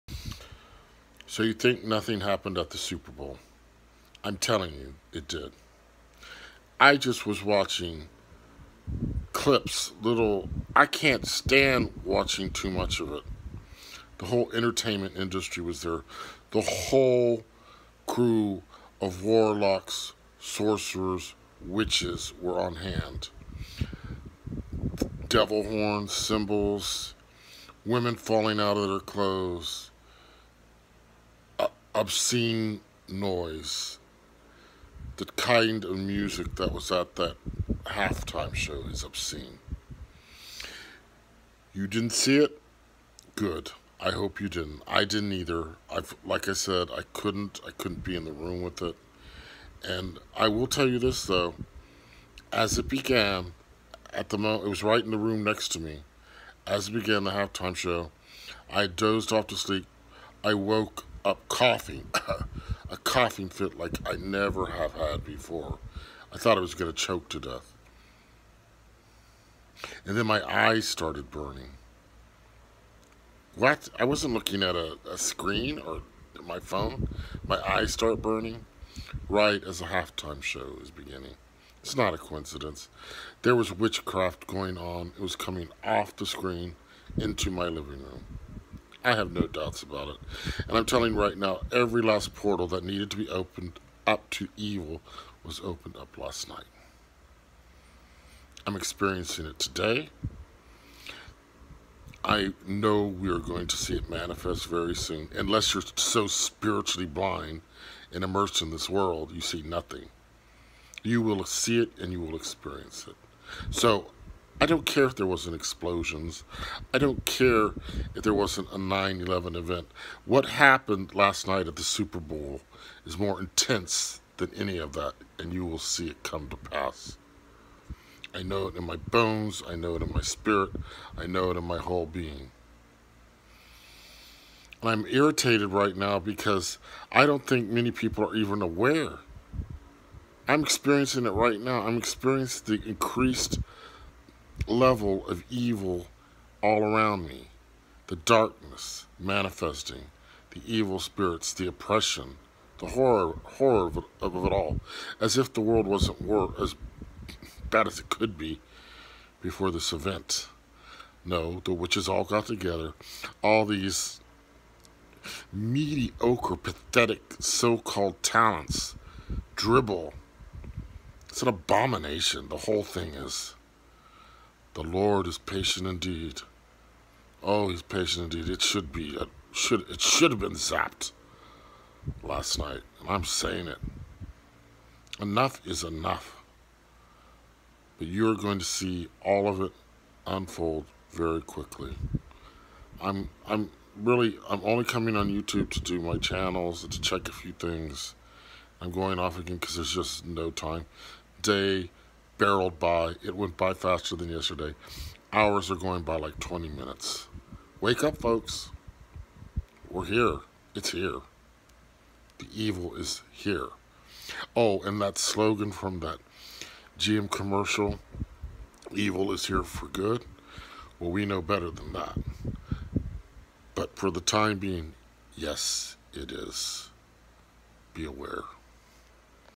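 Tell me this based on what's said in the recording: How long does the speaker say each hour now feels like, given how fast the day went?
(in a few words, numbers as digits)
20 minutes.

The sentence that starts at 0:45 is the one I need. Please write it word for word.
I've like I said, I couldn't I couldn't be in the room with it.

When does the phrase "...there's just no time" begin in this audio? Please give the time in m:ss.
3:19.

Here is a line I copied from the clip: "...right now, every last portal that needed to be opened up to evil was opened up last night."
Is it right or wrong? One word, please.
right.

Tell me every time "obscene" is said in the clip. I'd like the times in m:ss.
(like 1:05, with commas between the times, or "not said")
0:31, 0:39.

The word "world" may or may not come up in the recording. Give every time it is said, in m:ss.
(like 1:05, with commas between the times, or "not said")
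1:48, 2:35.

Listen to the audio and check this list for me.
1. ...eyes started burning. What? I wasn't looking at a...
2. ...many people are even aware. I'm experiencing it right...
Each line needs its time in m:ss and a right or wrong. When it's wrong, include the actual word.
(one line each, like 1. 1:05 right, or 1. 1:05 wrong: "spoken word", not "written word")
1. 1:10 right
2. 2:17 right.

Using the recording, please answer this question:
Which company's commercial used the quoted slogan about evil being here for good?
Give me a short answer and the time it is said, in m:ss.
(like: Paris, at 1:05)
GM, at 3:36.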